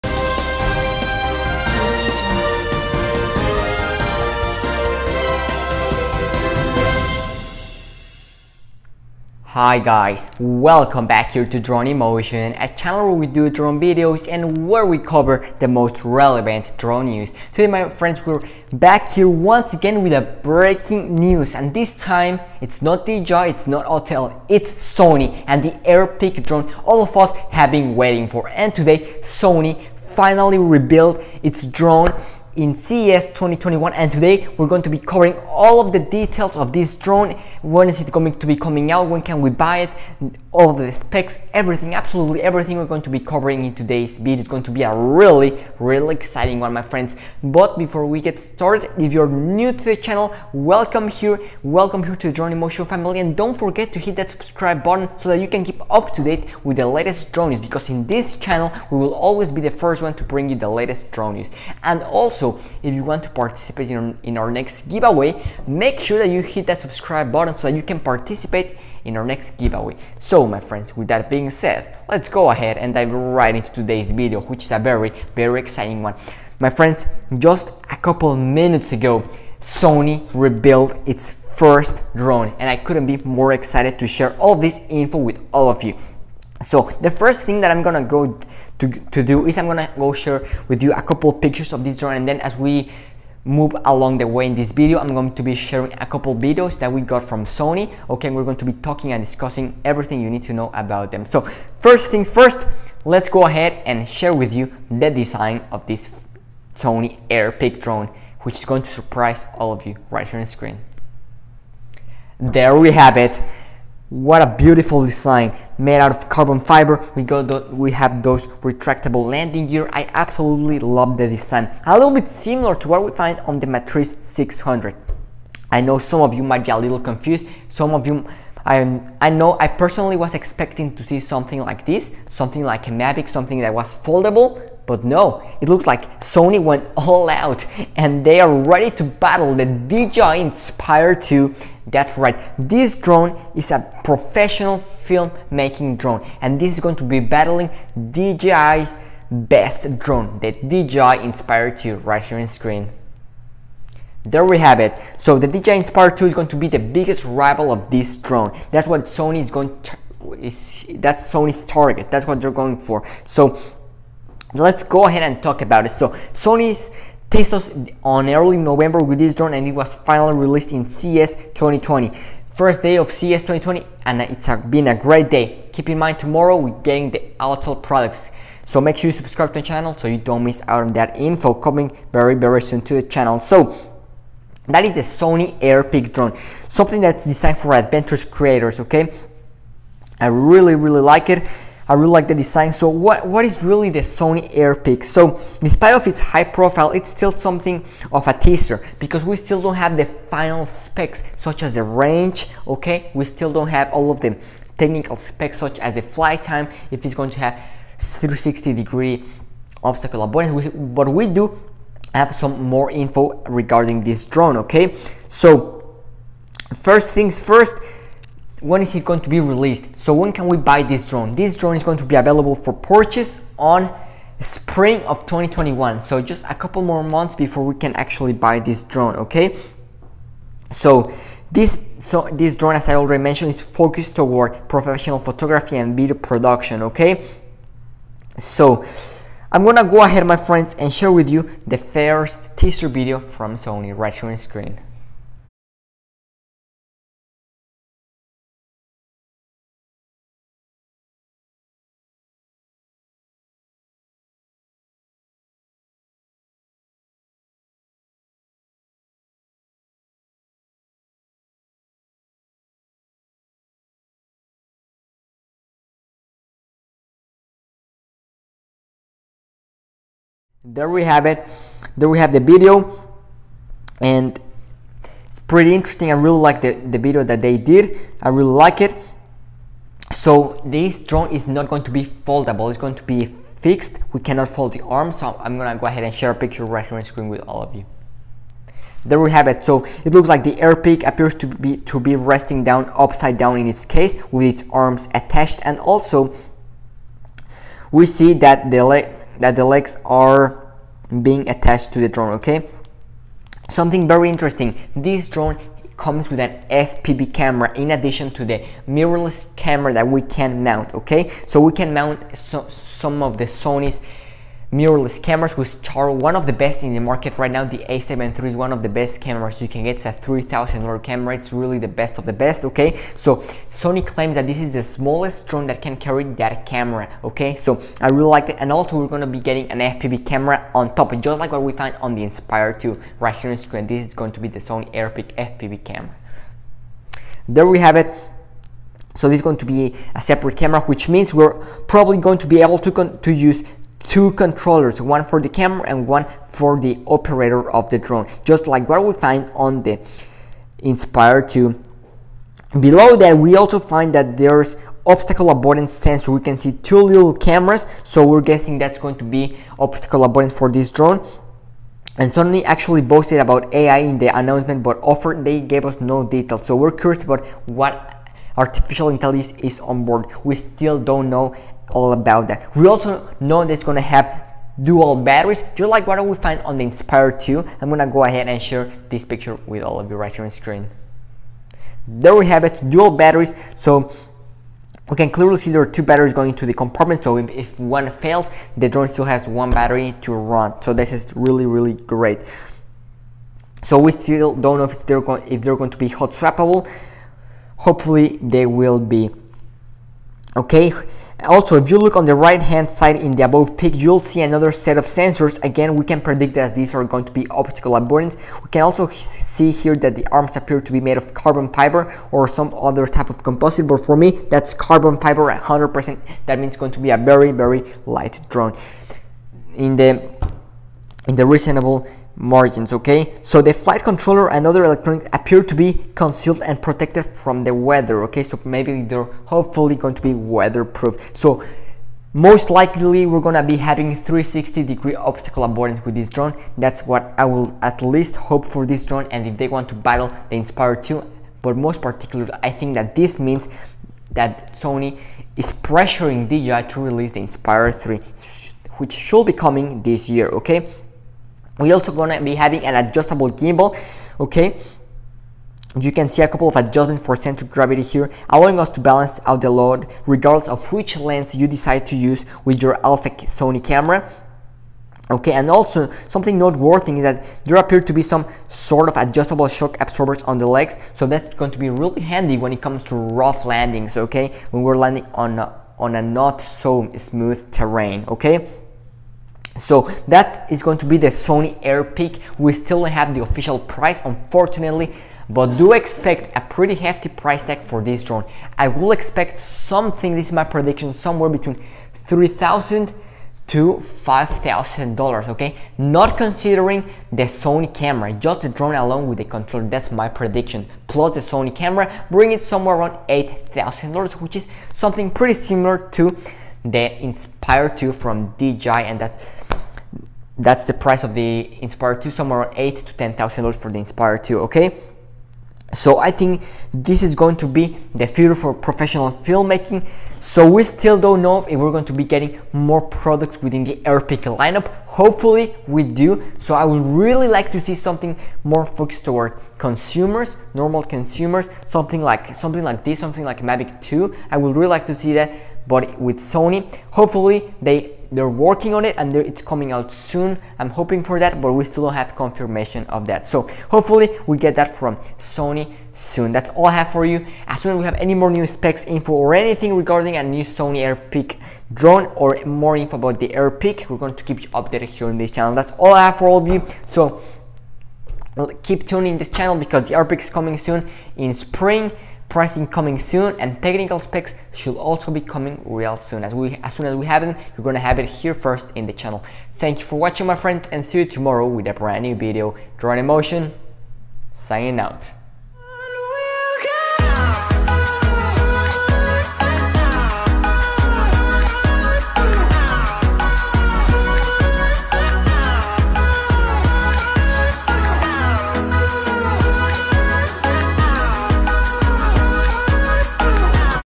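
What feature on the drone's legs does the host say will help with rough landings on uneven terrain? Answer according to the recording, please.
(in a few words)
Adjustable shock absorbers.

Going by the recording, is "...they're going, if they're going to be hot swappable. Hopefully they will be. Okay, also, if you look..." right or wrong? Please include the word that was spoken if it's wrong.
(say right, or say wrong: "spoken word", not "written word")
right.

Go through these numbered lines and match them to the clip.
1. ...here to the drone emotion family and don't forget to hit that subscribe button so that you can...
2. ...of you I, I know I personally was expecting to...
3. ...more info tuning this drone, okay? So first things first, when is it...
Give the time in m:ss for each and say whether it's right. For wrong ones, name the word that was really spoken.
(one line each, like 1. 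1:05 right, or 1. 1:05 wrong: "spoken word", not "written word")
1. 0:52 right
2. 2:07 right
3. 3:32 wrong: "regarding", not "tuning".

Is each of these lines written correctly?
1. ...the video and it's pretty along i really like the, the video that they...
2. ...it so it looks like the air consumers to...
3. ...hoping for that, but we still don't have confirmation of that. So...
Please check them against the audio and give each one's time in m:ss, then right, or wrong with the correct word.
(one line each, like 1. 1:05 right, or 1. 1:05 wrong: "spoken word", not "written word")
1. 4:32 wrong: "interesting", not "along"
2. 4:49 wrong: "appears", not "consumers"
3. 9:00 right.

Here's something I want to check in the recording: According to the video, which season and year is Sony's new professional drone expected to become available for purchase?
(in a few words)
Spring of 2021.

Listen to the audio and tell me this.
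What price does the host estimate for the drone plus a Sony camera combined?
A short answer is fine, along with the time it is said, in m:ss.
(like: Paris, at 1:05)
$8,000, at 8:23.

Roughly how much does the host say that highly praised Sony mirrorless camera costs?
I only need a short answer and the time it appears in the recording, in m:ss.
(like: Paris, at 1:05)
$3000, at 5:20.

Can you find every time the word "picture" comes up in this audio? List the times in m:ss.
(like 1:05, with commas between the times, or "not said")
1:31, 4:46, 6:19.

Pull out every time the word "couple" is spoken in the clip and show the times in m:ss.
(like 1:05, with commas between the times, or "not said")
1:17, 1:31, 1:36, 3:46, 7:36.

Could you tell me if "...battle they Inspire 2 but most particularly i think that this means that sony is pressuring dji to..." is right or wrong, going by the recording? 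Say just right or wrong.
right.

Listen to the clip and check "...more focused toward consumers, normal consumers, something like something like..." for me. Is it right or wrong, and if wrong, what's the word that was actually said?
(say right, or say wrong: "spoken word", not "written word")
right.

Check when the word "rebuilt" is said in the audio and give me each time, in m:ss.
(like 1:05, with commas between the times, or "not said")
0:30, 1:20.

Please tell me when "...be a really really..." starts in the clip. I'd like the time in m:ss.
0:44.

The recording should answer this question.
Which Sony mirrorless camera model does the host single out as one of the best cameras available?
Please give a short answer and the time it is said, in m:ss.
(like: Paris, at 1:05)
a7 III, at 5:17.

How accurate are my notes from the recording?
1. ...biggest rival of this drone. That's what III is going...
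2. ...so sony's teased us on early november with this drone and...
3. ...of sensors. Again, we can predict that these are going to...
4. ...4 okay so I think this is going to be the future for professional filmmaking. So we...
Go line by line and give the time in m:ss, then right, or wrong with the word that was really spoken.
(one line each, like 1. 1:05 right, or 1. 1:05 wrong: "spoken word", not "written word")
1. 2:36 wrong: "Sony", not "III"
2. 2:45 right
3. 6:44 right
4. 8:34 wrong: "2", not "4".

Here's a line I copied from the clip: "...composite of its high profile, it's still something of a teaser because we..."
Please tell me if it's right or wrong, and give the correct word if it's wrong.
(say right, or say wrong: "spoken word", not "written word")
wrong: "despite", not "composite".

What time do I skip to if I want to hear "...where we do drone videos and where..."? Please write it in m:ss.
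0:13.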